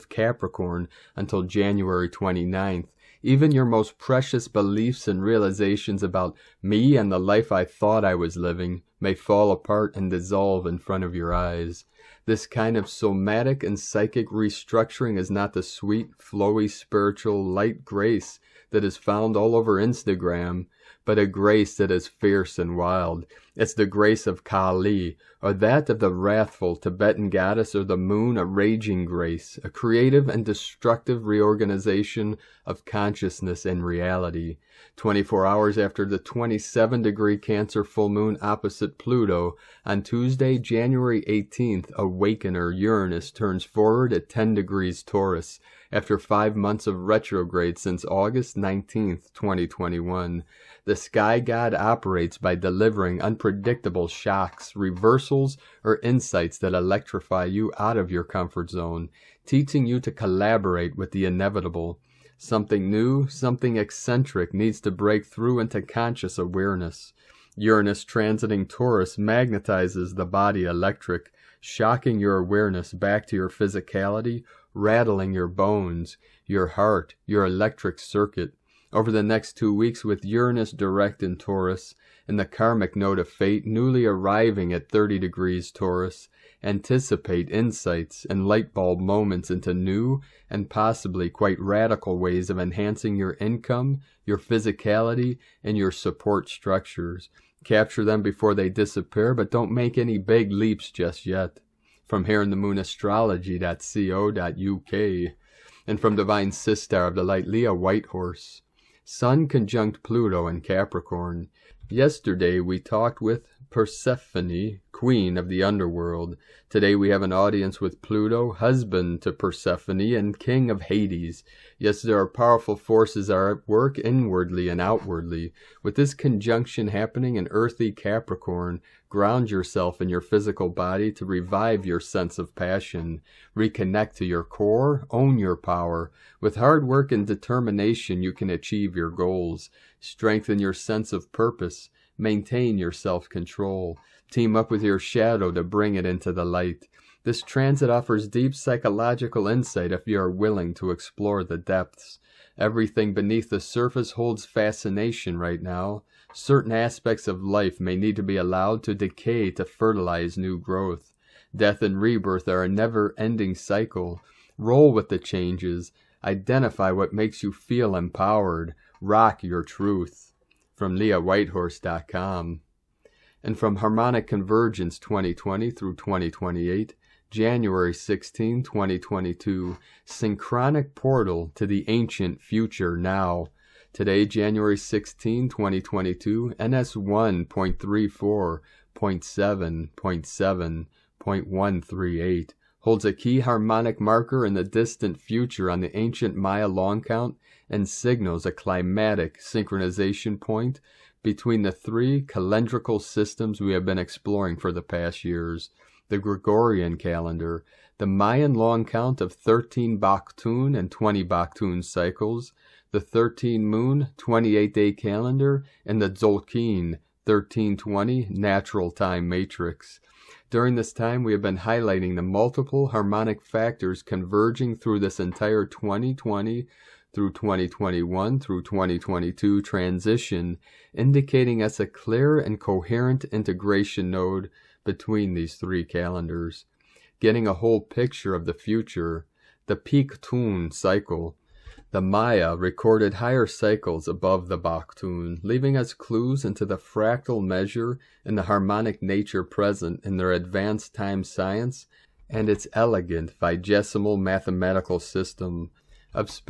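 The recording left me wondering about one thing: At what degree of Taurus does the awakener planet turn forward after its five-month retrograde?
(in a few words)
10 degrees.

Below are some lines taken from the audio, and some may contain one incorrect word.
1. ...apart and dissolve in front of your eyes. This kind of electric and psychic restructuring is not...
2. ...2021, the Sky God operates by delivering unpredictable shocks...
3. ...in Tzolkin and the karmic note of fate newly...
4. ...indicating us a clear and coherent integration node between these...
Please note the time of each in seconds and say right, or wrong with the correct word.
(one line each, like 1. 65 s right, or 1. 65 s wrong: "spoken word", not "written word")
1. 9 s wrong: "somatic", not "electric"
2. 49 s right
3. 81 s wrong: "Taurus", not "Tzolkin"
4. 230 s right.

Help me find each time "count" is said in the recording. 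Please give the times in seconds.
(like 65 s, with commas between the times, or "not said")
196 s, 208 s.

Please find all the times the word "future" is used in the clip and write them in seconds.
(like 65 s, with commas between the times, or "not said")
182 s, 195 s, 238 s.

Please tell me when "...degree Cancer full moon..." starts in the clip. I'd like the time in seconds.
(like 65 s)
37 s.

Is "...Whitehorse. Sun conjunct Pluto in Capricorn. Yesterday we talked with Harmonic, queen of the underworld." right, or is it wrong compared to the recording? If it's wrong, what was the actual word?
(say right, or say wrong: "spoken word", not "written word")
wrong: "Persephone", not "Harmonic".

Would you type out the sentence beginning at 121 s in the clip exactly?
Yes, there are powerful forces are at work inwardly and outwardly.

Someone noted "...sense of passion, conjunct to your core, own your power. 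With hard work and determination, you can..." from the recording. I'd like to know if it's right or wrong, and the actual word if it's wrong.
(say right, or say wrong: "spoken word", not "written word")
wrong: "reconnect", not "conjunct".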